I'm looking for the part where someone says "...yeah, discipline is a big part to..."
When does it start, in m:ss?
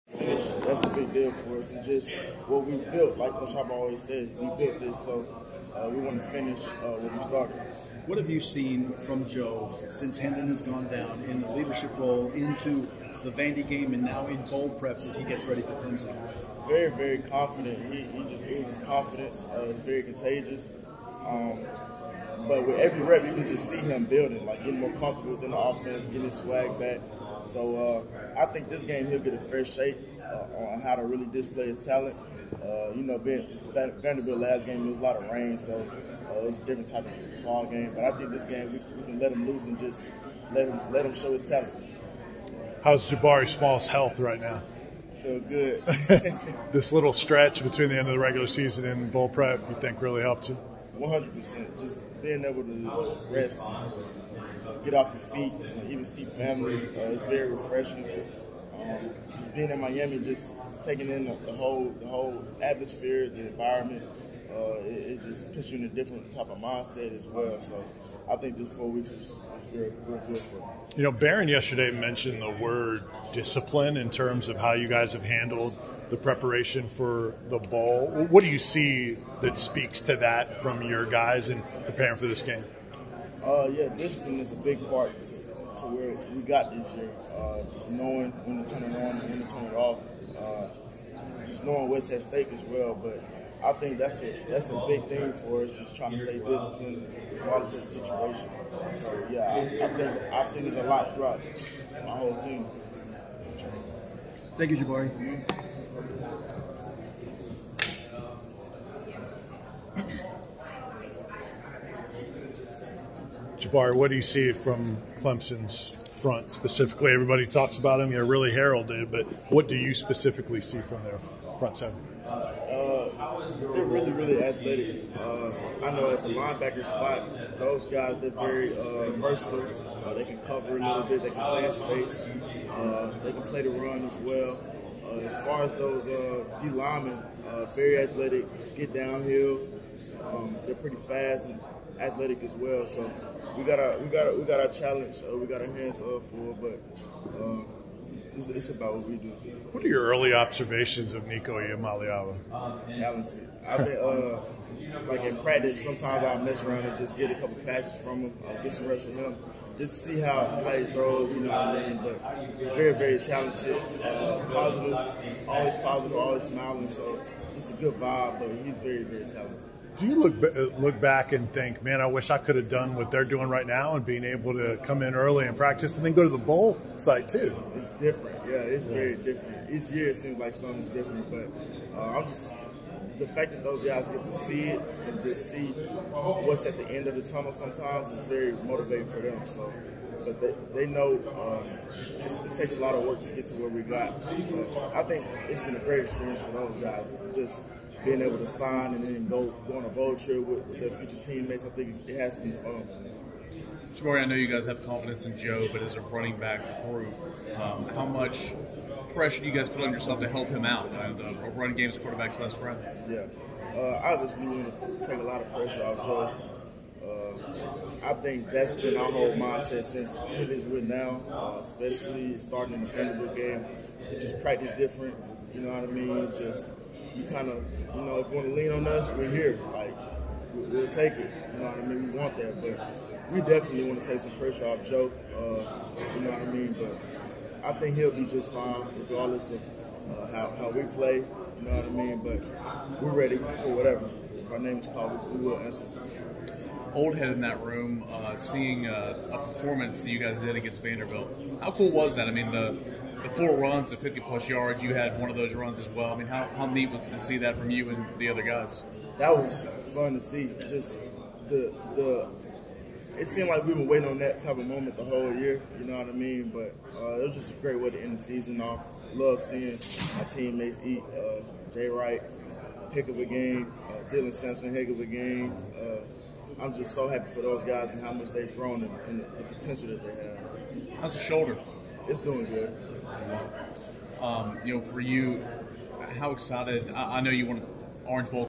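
1:23.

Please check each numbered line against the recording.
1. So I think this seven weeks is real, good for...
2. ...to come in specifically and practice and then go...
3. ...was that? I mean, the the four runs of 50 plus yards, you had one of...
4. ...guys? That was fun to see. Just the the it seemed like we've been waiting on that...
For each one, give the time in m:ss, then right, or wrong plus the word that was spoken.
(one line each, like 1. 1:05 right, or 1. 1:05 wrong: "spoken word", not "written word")
1. 1:07 wrong: "four", not "seven"
2. 2:54 wrong: "early", not "specifically"
3. 4:11 right
4. 4:18 right.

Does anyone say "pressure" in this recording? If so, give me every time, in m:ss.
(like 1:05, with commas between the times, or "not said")
3:29, 3:35, 3:54.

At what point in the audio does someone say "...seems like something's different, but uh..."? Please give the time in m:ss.
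3:00.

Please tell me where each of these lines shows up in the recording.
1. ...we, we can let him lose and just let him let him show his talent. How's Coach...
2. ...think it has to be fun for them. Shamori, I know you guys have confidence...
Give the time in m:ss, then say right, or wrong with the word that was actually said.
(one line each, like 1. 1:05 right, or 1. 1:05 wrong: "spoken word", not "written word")
1. 0:38 wrong: "Jabari", not "Coach"
2. 3:21 right.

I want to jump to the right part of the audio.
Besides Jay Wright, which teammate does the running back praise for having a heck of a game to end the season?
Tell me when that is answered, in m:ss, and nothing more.
4:34.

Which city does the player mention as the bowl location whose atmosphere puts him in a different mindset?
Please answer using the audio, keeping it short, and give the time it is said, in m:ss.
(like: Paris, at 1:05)
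Miami, at 0:59.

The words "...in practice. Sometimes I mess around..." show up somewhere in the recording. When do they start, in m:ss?
2:35.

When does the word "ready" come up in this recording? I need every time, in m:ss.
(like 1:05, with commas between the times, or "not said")
0:15, 4:03.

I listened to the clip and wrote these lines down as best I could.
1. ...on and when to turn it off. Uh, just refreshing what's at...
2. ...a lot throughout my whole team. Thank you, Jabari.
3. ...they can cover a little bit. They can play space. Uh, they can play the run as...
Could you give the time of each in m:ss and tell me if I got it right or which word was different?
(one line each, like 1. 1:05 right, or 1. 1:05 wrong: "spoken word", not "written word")
1. 1:28 wrong: "knowing", not "refreshing"
2. 1:40 right
3. 2:10 right.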